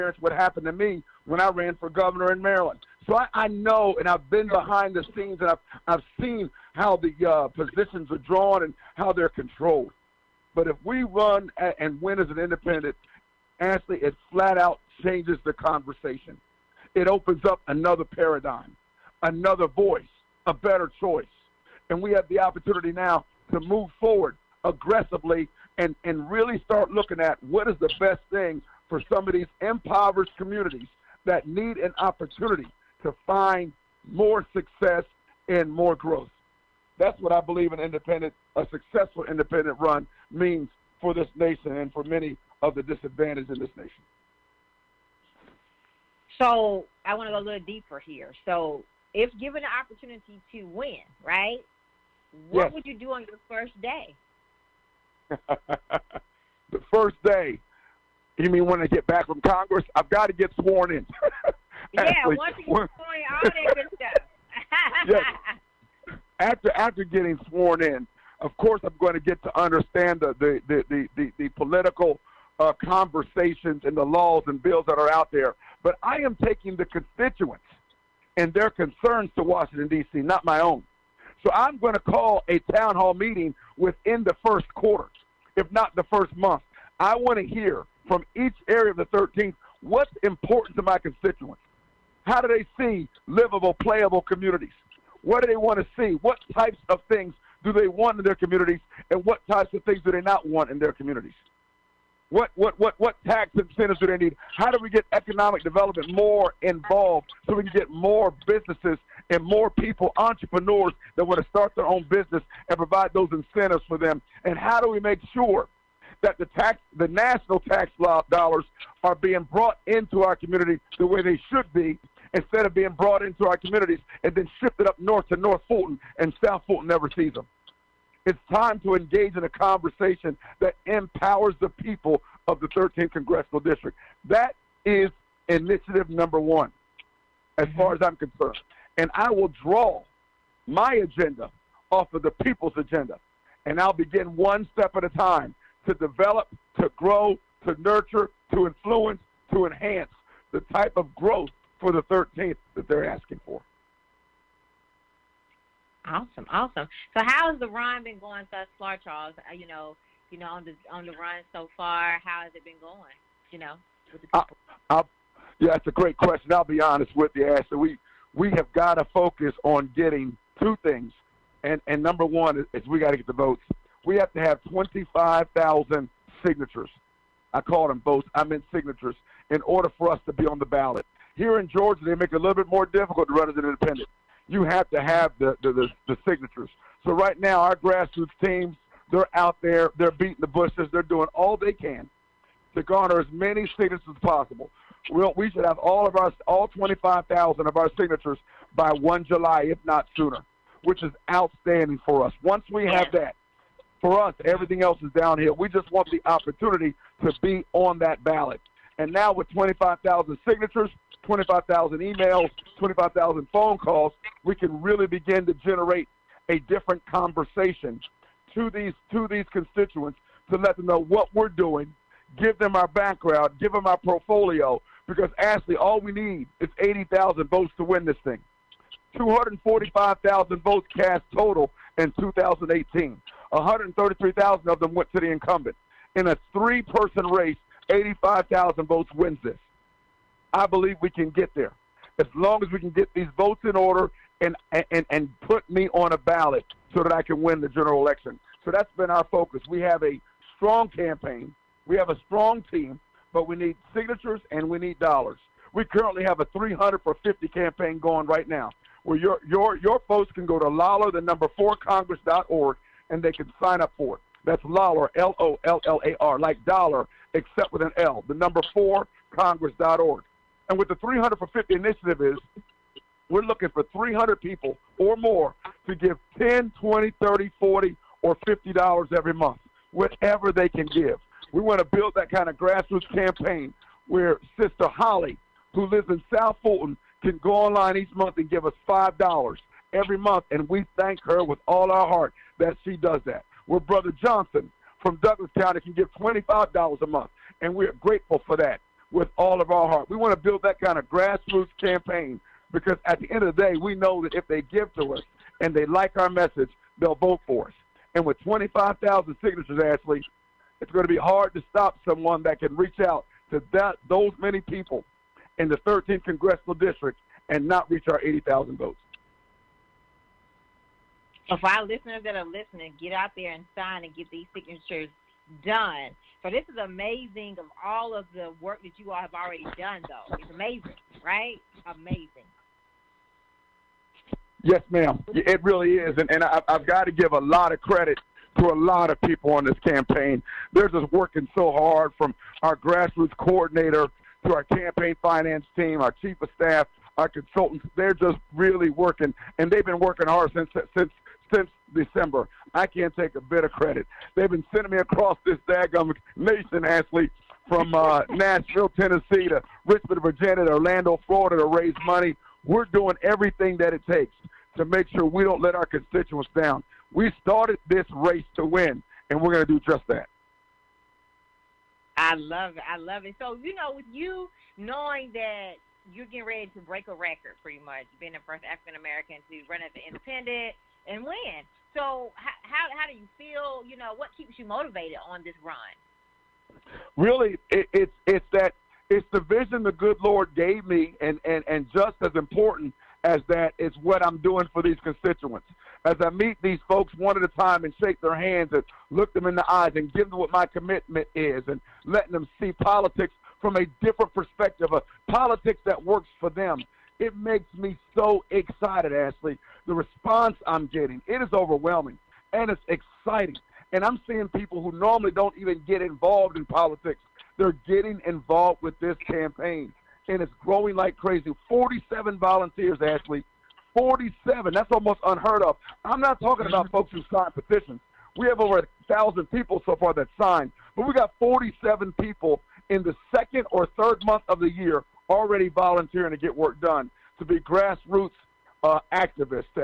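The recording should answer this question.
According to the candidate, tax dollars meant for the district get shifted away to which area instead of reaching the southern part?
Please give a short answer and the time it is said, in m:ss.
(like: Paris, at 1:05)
North Fulton, at 2:05.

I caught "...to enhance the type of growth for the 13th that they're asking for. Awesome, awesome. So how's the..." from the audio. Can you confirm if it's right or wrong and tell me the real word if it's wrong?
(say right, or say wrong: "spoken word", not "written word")
right.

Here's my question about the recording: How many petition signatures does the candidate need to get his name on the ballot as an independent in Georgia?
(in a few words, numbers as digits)
25,000.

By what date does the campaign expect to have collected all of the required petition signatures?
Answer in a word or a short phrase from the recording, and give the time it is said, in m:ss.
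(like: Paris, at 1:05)
1 July, at 3:18.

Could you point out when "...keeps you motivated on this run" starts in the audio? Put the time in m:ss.
6:24.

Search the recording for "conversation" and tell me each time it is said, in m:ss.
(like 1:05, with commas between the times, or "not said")
0:15, 1:12, 2:09, 3:37.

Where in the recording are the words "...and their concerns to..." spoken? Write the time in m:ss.
1:18.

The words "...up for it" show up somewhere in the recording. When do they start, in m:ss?
4:23.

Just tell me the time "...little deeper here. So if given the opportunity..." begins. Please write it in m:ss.
0:47.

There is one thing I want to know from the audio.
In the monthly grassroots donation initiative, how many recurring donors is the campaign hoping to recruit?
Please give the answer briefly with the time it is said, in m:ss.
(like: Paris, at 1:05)
300, at 4:33.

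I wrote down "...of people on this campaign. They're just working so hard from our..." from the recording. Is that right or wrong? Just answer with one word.
right.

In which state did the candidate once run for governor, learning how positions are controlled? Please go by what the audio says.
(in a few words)
Maryland.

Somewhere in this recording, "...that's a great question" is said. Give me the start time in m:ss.
2:45.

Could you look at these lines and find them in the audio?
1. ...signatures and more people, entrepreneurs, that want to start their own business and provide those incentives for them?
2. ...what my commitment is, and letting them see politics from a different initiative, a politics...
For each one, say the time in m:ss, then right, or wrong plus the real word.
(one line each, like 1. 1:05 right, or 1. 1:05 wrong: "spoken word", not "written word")
1. 1:48 wrong: "businesses", not "signatures"
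2. 6:40 wrong: "perspective", not "initiative".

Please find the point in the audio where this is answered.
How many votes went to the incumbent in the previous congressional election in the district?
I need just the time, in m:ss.
3:53.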